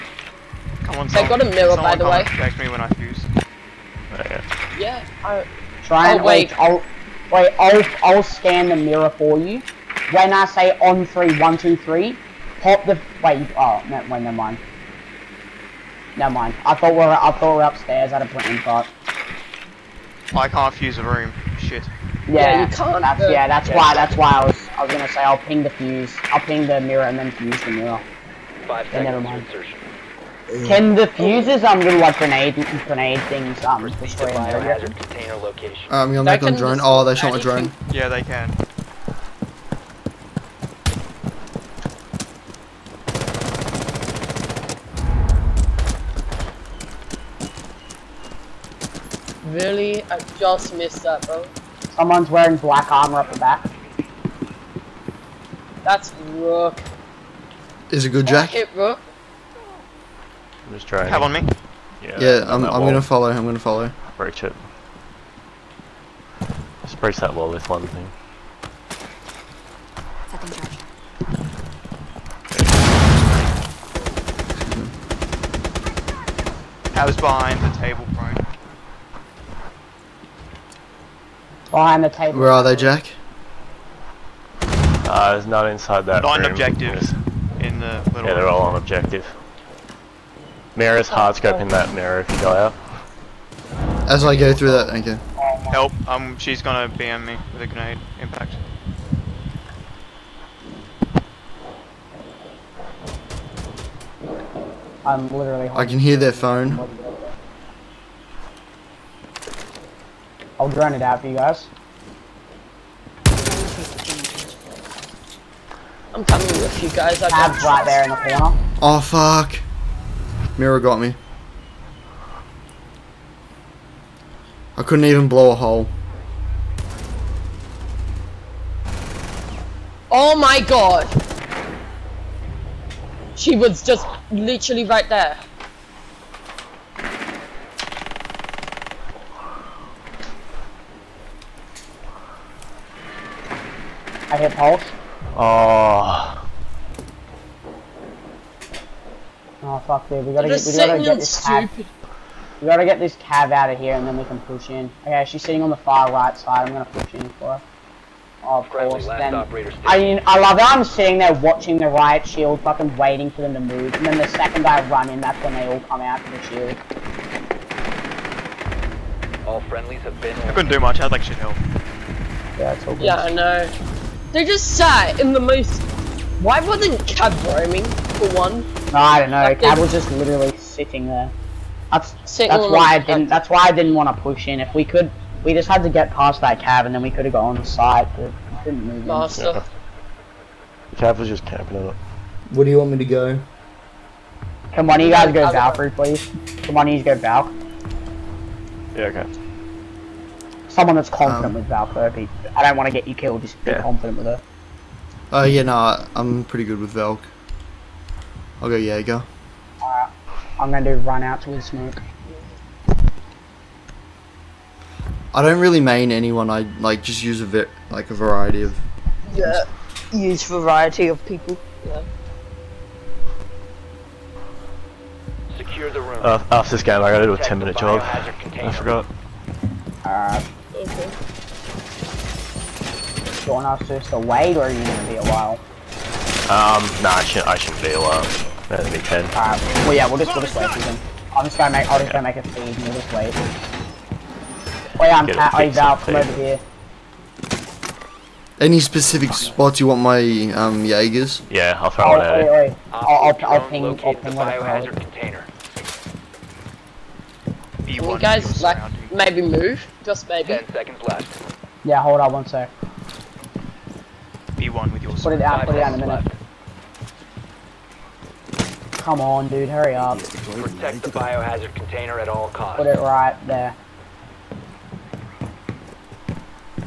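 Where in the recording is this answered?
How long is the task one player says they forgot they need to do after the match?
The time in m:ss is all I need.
3:47.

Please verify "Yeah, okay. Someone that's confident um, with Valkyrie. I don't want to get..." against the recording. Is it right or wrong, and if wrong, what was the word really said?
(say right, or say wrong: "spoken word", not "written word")
right.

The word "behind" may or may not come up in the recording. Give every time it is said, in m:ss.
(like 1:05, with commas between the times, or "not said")
1:17, 1:21.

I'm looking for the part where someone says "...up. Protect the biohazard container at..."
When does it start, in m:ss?
4:29.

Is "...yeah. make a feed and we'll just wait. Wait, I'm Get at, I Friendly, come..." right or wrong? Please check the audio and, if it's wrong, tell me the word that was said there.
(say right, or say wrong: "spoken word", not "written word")
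wrong: "Val", not "Friendly".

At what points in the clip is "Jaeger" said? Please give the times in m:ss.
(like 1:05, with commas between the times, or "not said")
3:28, 4:10.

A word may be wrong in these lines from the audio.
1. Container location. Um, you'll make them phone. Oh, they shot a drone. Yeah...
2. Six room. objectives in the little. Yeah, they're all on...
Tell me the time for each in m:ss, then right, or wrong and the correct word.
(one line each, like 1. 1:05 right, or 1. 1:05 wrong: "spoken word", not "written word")
1. 0:34 wrong: "drone", not "phone"
2. 1:26 wrong: "Nine", not "Six".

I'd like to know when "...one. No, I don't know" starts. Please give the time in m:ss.
2:58.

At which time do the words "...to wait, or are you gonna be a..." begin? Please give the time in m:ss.
3:54.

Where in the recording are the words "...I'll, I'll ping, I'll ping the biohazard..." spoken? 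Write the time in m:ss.
4:13.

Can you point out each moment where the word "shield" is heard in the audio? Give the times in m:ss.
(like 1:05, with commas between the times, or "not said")
2:42, 2:46.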